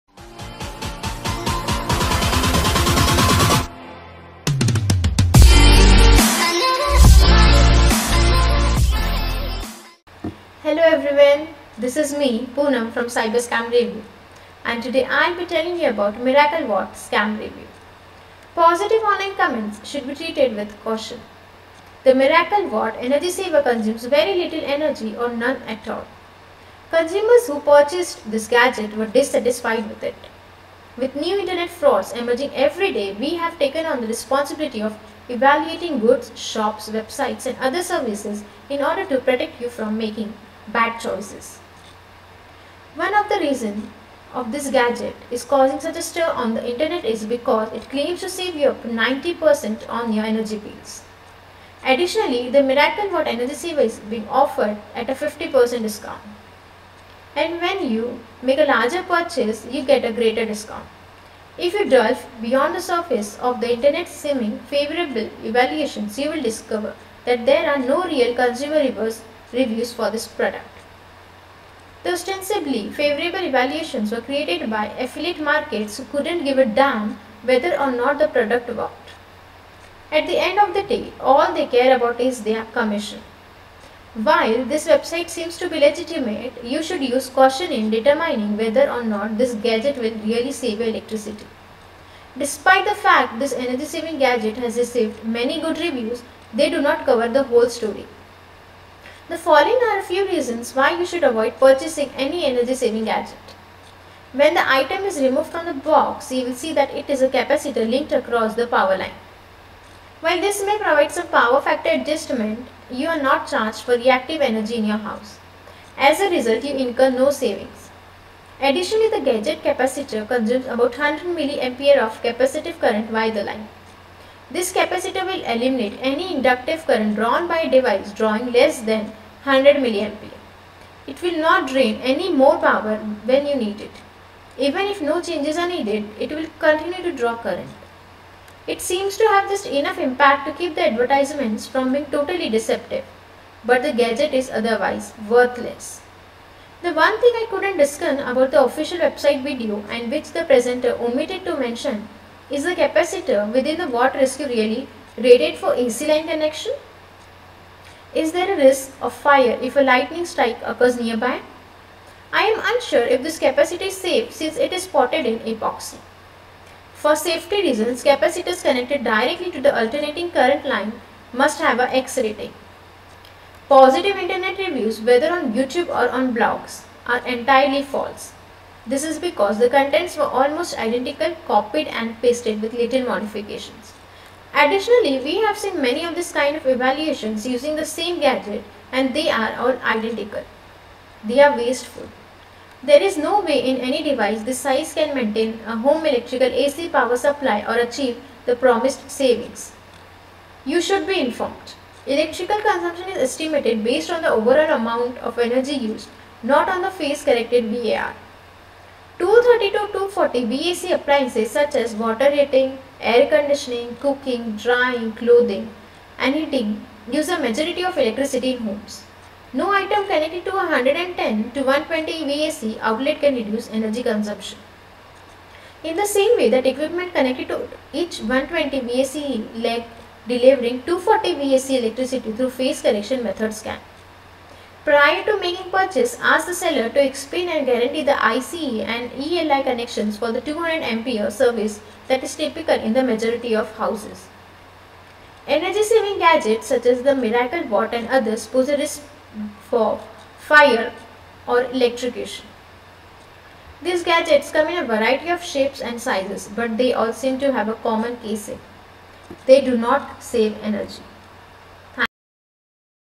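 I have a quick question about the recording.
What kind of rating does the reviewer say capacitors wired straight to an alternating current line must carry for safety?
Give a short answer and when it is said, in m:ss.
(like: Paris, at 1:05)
X rating, at 2:51.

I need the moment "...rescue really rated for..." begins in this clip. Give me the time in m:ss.
2:34.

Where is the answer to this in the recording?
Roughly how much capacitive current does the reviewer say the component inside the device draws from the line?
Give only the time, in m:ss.
2:00.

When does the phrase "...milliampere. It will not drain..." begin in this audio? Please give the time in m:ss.
2:09.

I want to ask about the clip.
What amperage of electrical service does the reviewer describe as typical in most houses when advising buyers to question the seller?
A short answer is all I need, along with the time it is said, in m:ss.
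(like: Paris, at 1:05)
200 amperes, at 4:00.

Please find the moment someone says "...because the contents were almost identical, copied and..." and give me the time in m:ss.
2:59.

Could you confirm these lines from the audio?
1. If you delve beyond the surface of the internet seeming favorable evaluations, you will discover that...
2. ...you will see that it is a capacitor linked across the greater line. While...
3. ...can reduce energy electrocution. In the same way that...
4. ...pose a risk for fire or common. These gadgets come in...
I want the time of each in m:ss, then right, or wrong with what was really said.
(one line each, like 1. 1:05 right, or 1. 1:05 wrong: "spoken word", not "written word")
1. 1:01 right
2. 1:46 wrong: "power", not "greater"
3. 3:43 wrong: "consumption", not "electrocution"
4. 4:08 wrong: "electrocution", not "common".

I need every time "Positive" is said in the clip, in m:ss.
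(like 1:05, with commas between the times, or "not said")
0:18, 2:53.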